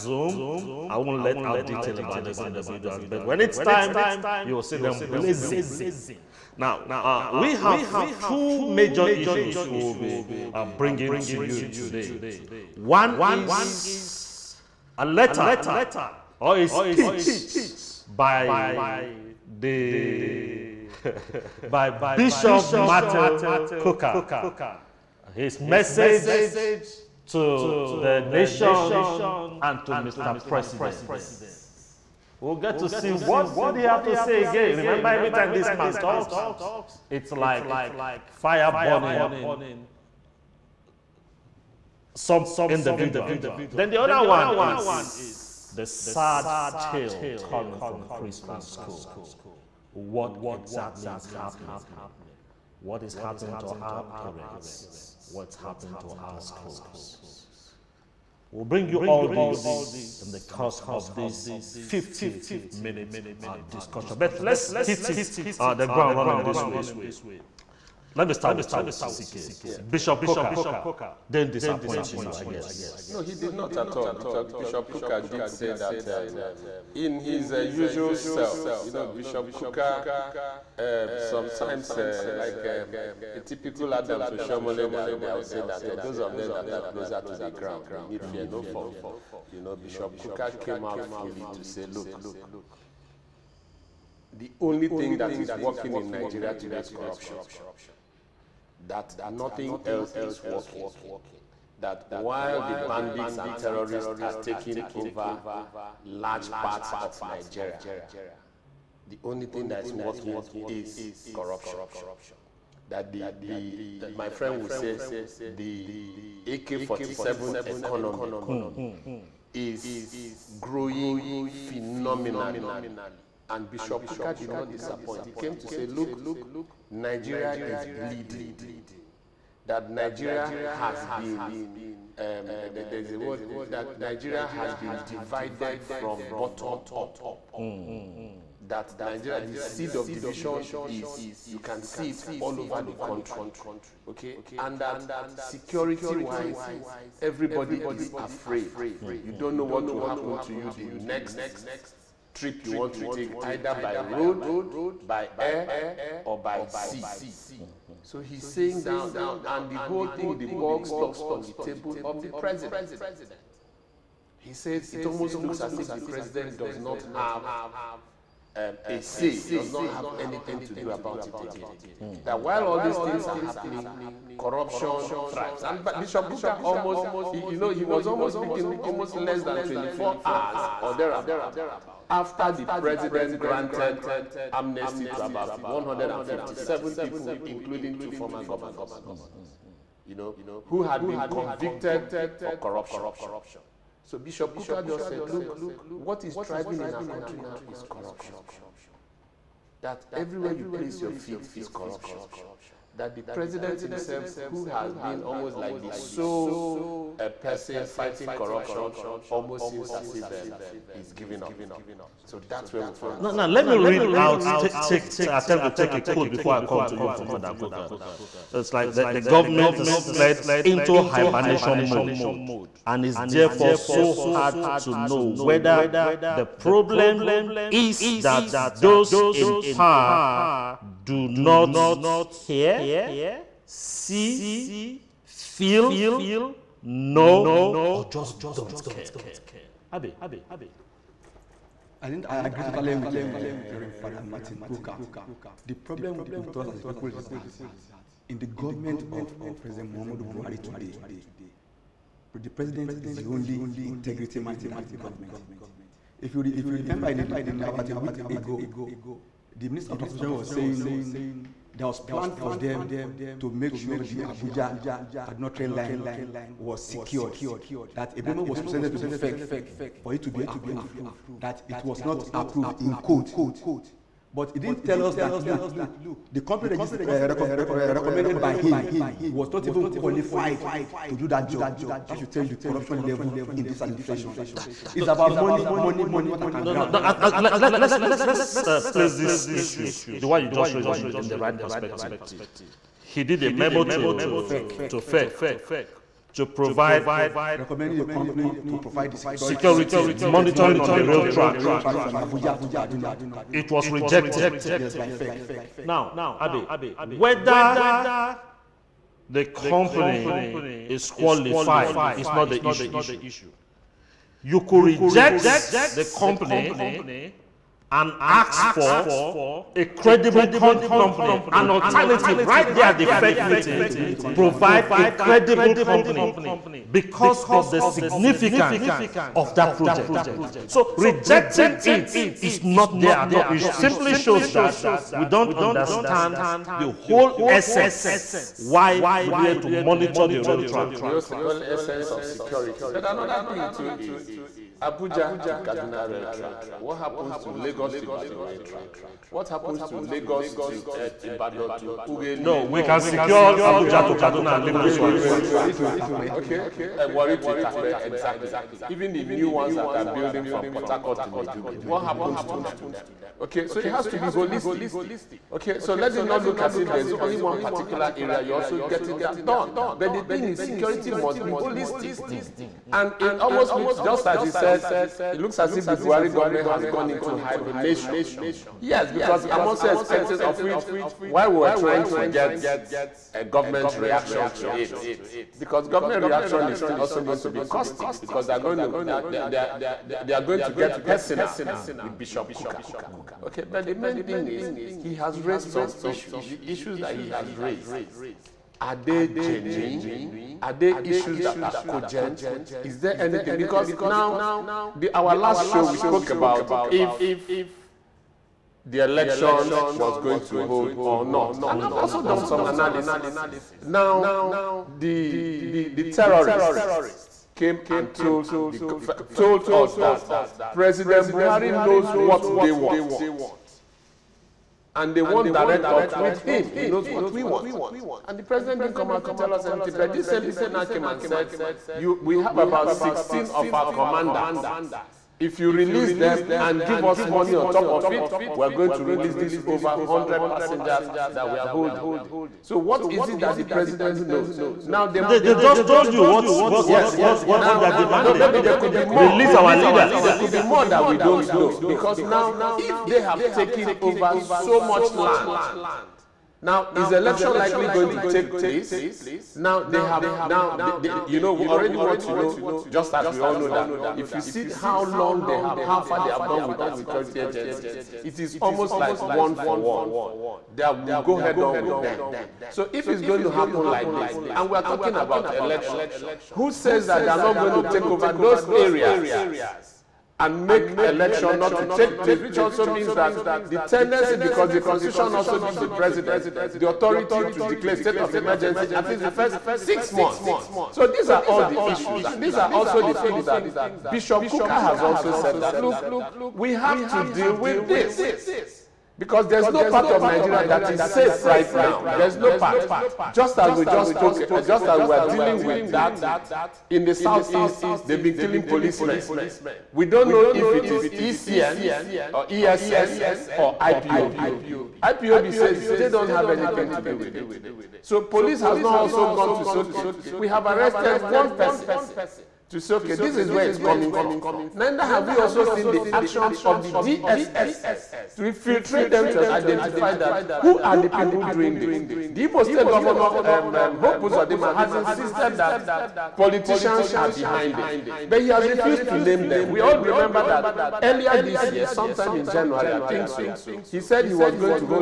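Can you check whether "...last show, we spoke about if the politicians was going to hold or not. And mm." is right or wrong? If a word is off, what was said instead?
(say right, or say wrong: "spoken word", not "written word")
wrong: "elections", not "politicians".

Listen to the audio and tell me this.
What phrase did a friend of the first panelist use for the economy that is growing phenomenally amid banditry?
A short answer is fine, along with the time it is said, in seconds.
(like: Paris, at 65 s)
AK-47 economy, at 116 s.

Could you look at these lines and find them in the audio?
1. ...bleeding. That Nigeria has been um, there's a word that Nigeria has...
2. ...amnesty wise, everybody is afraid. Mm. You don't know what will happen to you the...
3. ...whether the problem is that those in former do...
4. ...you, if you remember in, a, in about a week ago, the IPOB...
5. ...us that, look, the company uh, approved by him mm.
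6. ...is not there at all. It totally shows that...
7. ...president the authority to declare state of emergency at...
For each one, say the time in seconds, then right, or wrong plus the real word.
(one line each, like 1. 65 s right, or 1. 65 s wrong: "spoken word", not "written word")
1. 127 s right
2. 145 s wrong: "security", not "amnesty"
3. 225 s wrong: "power", not "former"
4. 256 s wrong: "Minister", not "IPOB"
5. 275 s wrong: "recommended", not "approved"
6. 332 s wrong: "simply", not "totally"
7. 485 s right.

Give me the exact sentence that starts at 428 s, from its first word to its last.
And the president didn't come out to tell us anything.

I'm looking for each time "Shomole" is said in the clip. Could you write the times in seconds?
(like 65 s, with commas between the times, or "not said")
84 s.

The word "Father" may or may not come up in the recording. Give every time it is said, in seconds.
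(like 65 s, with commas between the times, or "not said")
217 s, 243 s.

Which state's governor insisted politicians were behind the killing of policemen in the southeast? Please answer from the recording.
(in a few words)
Imo State.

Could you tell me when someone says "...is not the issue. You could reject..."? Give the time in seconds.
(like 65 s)
312 s.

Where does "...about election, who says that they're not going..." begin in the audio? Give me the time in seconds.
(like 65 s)
475 s.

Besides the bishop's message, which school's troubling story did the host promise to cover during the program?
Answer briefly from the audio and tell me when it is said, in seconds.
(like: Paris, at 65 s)
Chrisland School, at 48 s.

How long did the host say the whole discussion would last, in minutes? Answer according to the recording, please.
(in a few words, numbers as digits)
50.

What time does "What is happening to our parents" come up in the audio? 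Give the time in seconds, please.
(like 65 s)
52 s.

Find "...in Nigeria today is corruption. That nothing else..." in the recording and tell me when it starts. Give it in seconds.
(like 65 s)
95 s.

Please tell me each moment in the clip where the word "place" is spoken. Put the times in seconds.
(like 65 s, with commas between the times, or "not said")
200 s, 288 s, 458 s, 482 s.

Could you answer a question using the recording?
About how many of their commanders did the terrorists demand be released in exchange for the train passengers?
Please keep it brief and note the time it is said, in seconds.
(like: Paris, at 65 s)
16, at 432 s.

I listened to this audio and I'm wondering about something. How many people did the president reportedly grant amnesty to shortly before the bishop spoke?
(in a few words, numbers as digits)
157.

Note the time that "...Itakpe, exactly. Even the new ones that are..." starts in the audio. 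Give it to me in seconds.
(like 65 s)
357 s.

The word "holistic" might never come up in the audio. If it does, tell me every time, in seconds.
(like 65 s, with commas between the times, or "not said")
364 s, 371 s.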